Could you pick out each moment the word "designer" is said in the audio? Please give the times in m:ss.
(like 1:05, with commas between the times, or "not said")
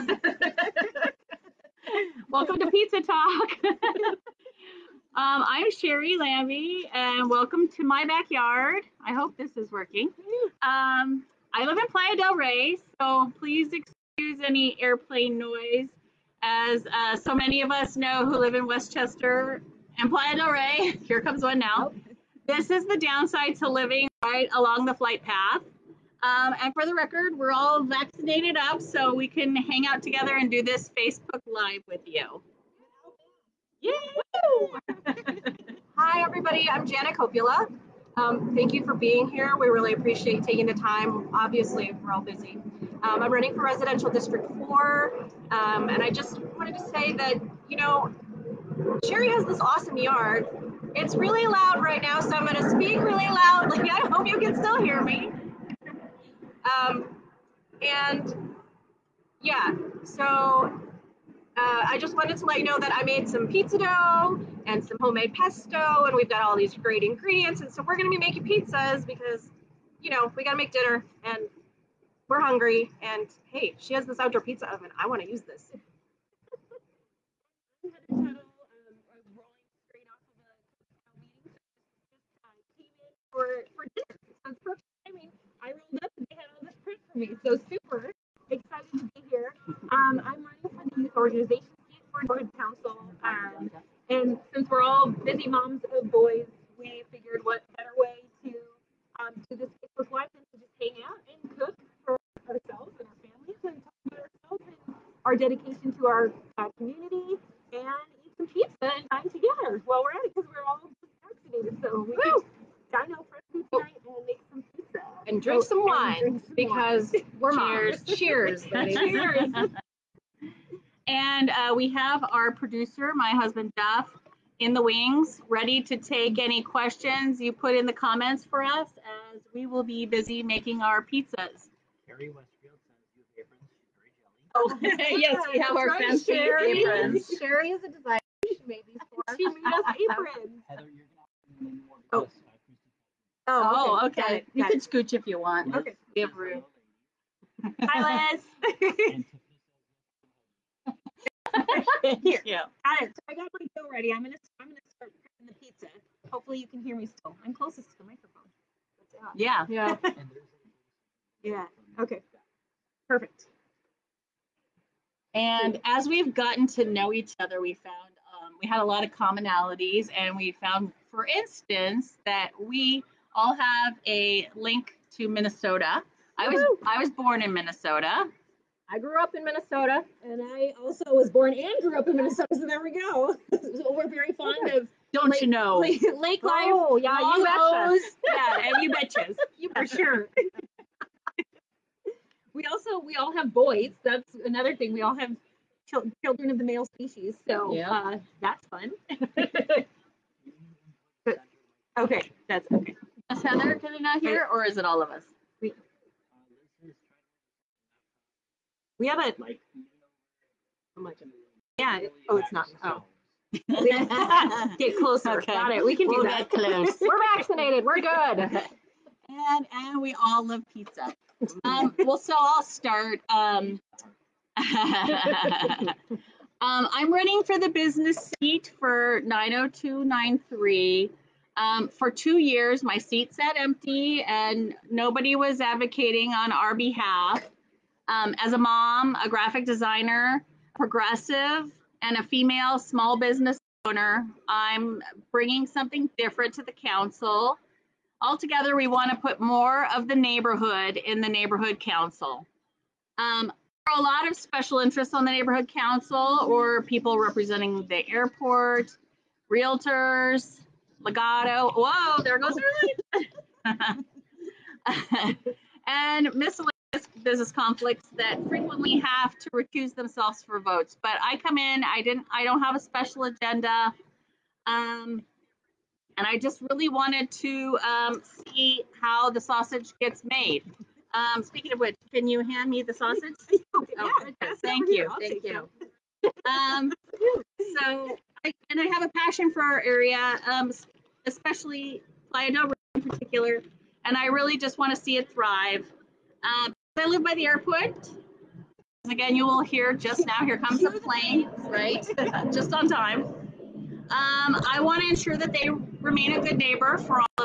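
2:17, 3:59.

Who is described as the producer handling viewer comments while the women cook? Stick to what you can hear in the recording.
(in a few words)
Duff.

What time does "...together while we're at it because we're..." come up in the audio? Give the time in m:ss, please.
1:49.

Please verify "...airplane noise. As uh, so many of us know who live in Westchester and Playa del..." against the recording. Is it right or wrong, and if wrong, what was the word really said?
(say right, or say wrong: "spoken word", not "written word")
right.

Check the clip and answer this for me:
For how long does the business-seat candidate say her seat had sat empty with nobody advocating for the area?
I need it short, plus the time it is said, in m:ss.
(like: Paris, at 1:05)
2 years, at 3:52.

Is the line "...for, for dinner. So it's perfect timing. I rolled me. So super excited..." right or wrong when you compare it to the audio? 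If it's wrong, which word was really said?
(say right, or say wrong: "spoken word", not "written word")
right.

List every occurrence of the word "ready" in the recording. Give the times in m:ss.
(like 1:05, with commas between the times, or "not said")
2:05, 2:33.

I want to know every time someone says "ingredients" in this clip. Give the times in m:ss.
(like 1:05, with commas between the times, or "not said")
1:07.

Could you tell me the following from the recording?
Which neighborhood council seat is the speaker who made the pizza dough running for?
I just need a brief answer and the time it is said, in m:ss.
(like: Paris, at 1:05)
Residential District 4, at 0:43.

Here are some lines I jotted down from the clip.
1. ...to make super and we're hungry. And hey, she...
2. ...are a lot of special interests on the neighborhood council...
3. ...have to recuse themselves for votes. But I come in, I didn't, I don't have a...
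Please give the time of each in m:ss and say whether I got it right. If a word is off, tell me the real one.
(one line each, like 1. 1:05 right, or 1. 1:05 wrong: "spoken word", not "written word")
1. 1:10 wrong: "dinner", not "super"
2. 4:13 right
3. 4:28 right.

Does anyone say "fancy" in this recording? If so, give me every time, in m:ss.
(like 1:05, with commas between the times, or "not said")
2:15.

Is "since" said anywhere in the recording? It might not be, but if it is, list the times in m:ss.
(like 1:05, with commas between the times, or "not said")
1:34.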